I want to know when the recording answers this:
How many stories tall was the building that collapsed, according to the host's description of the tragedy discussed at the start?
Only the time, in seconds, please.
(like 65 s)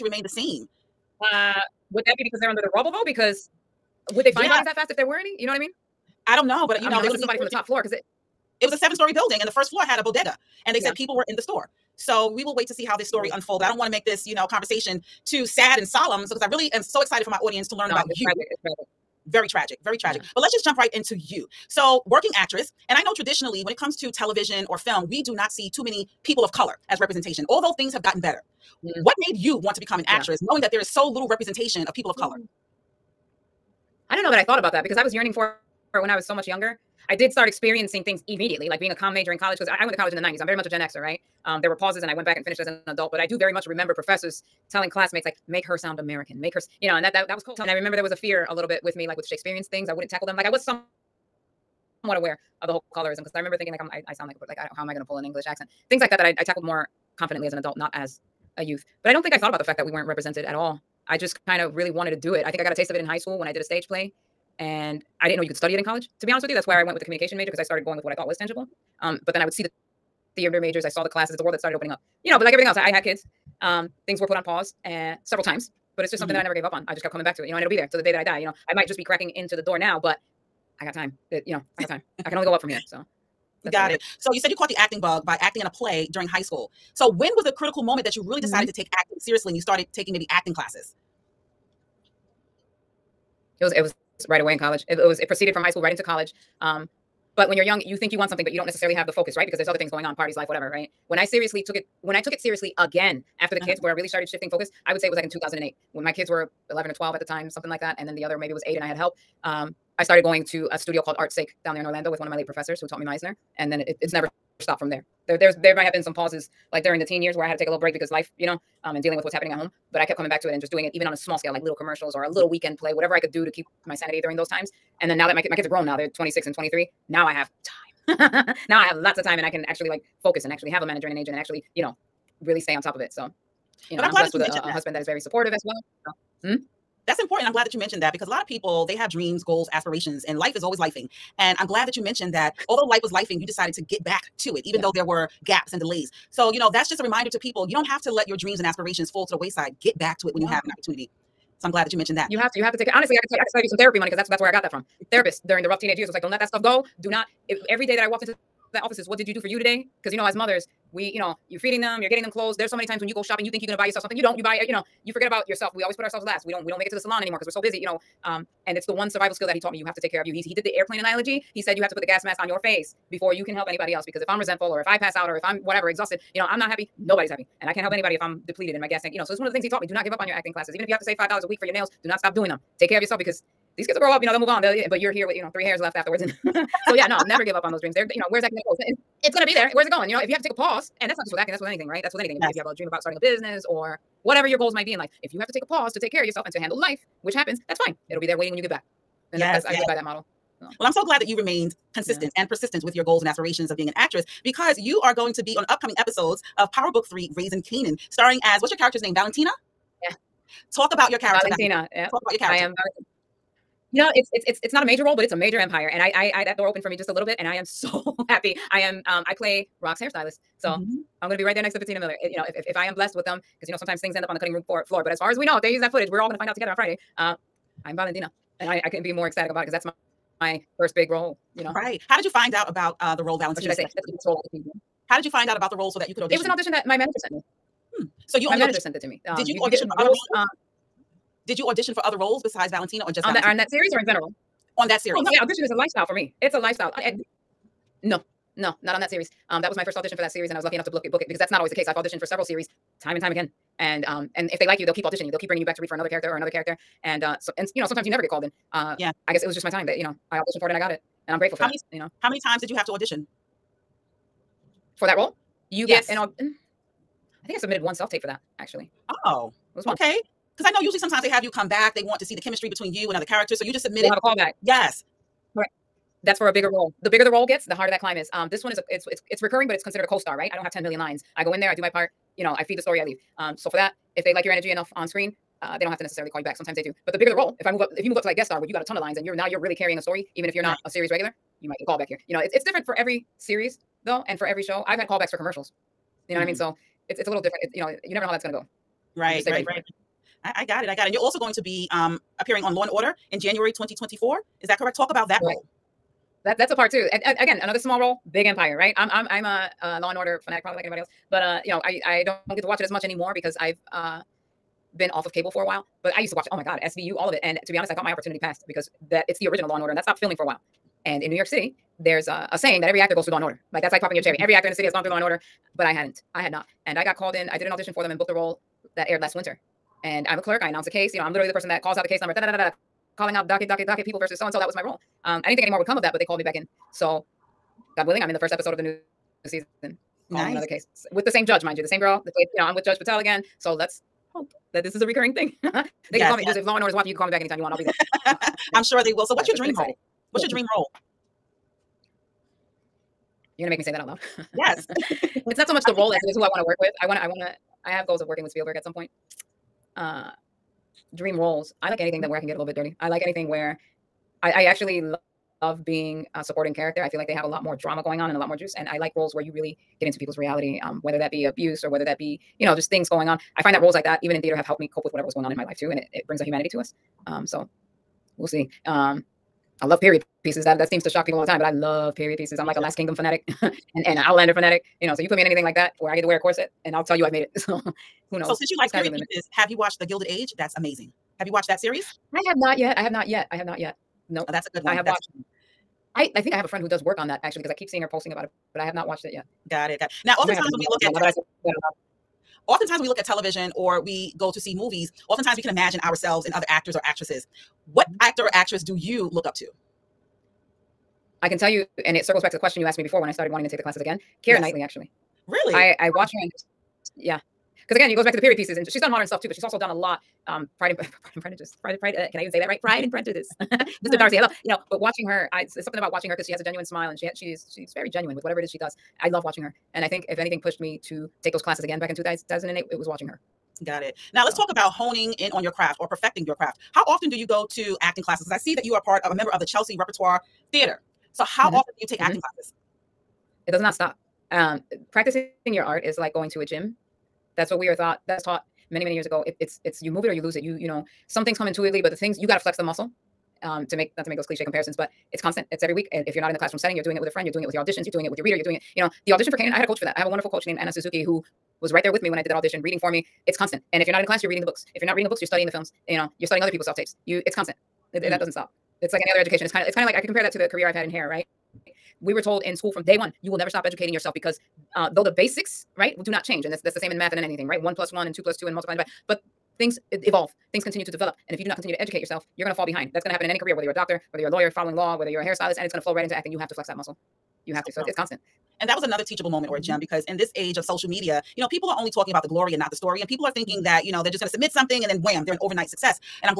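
8 s.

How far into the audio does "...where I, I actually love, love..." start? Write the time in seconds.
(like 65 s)
363 s.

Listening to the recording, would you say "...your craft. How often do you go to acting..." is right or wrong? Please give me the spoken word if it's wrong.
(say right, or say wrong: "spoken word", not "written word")
right.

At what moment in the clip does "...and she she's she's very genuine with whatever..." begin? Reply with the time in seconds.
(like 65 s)
427 s.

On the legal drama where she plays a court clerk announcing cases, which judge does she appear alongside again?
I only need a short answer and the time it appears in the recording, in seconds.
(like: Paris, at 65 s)
Judge Patel, at 342 s.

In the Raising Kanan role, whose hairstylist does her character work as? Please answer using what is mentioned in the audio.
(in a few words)
Rock's.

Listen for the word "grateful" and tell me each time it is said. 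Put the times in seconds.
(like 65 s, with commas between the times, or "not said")
261 s.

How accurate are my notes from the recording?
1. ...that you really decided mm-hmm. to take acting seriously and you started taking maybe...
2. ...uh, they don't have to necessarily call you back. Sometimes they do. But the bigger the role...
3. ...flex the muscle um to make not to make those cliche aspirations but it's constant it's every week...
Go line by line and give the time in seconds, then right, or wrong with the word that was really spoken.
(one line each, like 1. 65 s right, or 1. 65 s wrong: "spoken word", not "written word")
1. 88 s right
2. 285 s right
3. 452 s wrong: "comparisons", not "aspirations".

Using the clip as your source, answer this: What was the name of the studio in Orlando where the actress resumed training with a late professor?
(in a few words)
Art Sake.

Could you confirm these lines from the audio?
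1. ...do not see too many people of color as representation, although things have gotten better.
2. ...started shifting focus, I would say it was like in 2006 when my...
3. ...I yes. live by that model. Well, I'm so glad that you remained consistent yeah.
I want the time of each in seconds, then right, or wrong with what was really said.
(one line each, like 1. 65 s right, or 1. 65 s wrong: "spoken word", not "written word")
1. 25 s right
2. 104 s wrong: "2008", not "2006"
3. 199 s right.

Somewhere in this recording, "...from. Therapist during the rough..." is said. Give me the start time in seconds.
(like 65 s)
154 s.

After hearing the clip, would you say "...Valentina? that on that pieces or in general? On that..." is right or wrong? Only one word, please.
wrong.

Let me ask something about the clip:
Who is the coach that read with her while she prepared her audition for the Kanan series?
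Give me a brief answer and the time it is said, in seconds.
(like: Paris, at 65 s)
Anna Suzuki, at 460 s.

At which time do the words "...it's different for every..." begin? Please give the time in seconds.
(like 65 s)
292 s.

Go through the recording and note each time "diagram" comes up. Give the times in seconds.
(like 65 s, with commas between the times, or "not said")
not said.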